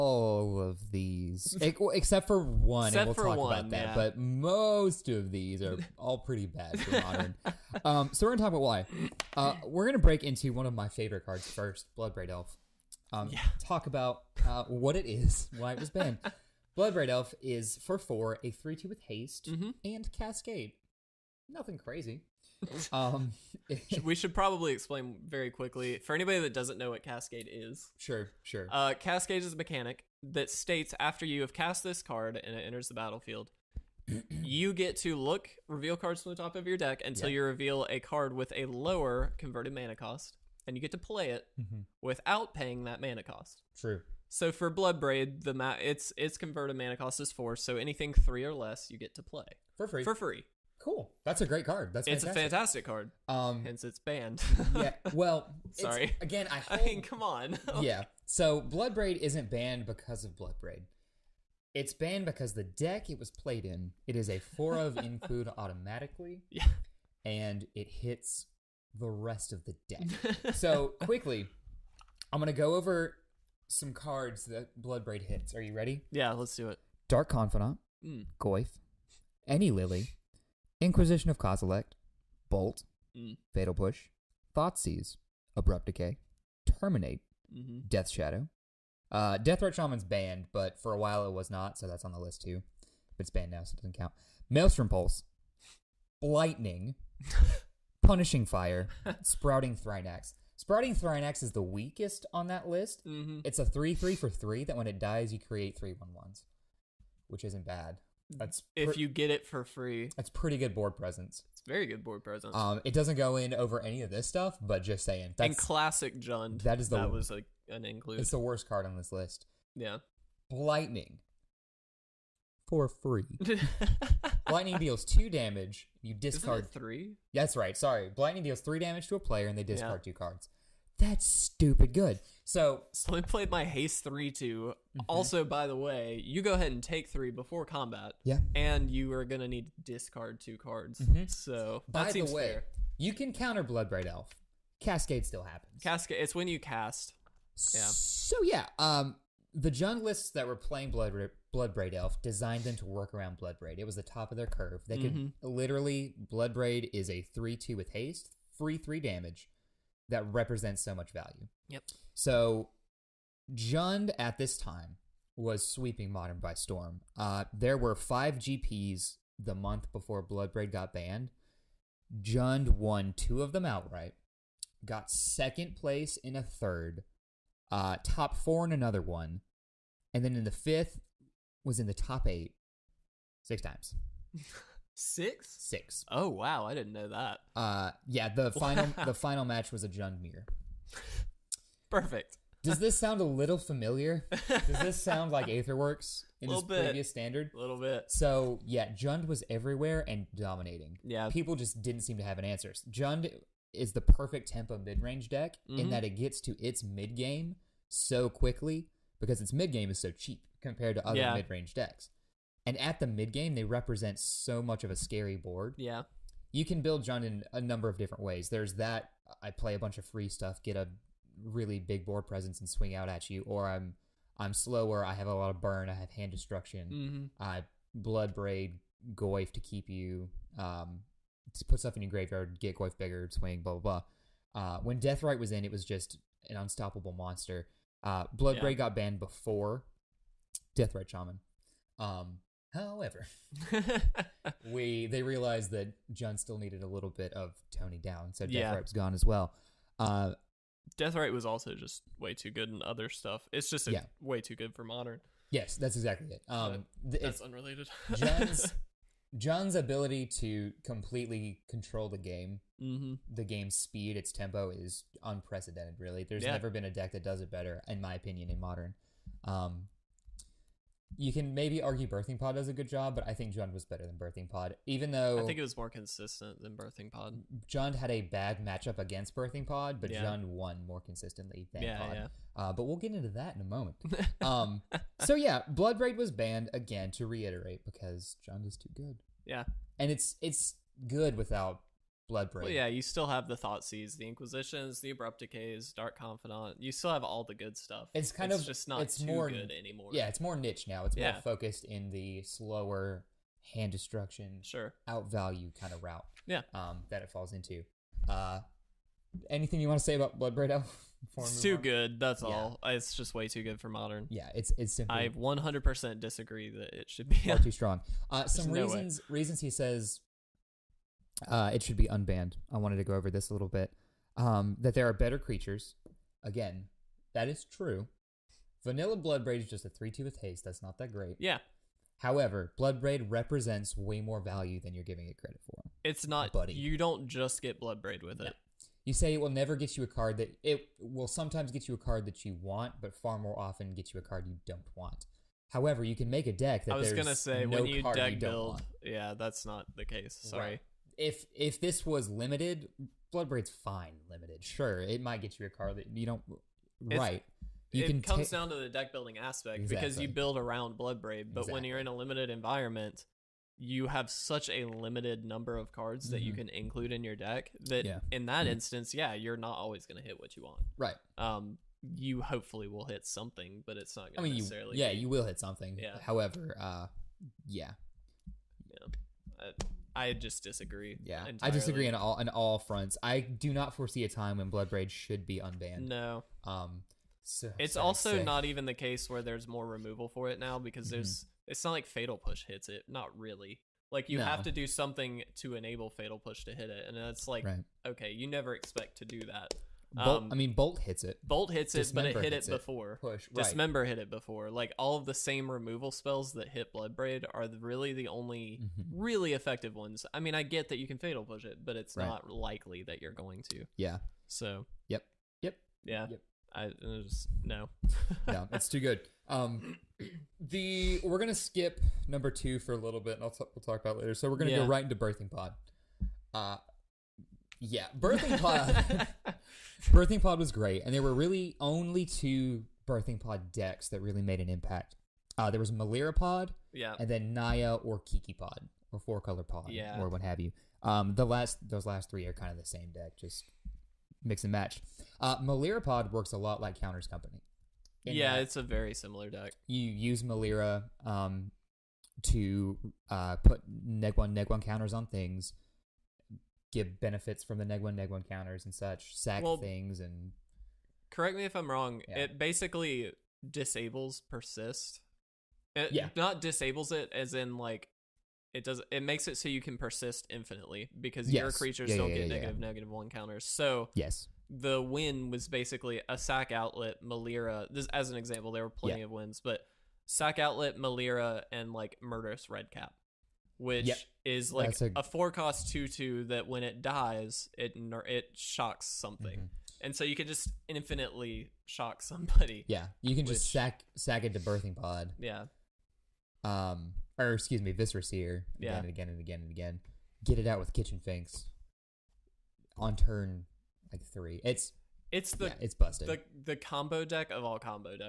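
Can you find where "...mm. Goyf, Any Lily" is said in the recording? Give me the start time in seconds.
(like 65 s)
78 s.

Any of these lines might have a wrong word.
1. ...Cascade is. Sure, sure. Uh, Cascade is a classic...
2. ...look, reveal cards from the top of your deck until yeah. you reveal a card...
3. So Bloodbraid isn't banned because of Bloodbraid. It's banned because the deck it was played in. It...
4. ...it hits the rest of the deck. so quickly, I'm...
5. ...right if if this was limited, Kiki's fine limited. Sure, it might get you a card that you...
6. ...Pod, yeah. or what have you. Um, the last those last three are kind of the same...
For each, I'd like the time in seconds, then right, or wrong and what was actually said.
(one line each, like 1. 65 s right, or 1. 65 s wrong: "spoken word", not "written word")
1. 27 s wrong: "mechanic", not "classic"
2. 35 s right
3. 58 s right
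4. 67 s right
5. 350 s wrong: "Bloodbraid", not "Kiki"
6. 439 s right.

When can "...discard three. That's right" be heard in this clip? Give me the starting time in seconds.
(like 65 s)
126 s.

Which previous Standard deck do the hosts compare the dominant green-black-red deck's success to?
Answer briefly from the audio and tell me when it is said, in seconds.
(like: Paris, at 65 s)
Aetherworks, at 195 s.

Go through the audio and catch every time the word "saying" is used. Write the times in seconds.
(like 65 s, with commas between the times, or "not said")
115 s.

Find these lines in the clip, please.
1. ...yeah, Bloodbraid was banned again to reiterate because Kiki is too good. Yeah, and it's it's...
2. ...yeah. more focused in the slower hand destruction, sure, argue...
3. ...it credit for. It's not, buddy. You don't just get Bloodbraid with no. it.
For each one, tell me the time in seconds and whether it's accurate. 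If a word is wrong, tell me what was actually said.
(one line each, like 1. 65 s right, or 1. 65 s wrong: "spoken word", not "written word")
1. 285 s wrong: "Jund", not "Kiki"
2. 301 s wrong: "outvalue", not "argue"
3. 335 s right.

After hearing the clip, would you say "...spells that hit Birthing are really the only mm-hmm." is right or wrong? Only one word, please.
wrong.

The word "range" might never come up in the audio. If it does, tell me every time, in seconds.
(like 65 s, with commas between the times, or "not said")
205 s, 211 s.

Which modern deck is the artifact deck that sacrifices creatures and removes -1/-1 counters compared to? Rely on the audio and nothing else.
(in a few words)
Counters Company.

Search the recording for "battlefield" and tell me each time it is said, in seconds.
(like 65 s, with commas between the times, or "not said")
32 s.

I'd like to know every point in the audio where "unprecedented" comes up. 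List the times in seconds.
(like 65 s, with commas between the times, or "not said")
265 s.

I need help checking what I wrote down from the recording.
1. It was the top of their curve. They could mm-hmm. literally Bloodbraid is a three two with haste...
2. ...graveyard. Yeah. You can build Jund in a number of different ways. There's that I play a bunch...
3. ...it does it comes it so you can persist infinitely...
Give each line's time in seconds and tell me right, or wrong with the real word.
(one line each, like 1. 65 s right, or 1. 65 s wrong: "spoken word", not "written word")
1. 153 s right
2. 215 s wrong: "board", not "graveyard"
3. 468 s wrong: "makes", not "comes".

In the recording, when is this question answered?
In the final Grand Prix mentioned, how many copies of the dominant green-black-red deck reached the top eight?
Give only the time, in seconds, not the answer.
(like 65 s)
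183 s.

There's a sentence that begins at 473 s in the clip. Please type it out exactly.
So yes, the win was basically a sack outlet Melira.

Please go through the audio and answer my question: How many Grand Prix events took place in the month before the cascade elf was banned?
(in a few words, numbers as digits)
5.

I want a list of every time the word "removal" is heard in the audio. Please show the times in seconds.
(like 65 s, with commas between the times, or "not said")
389 s, 405 s.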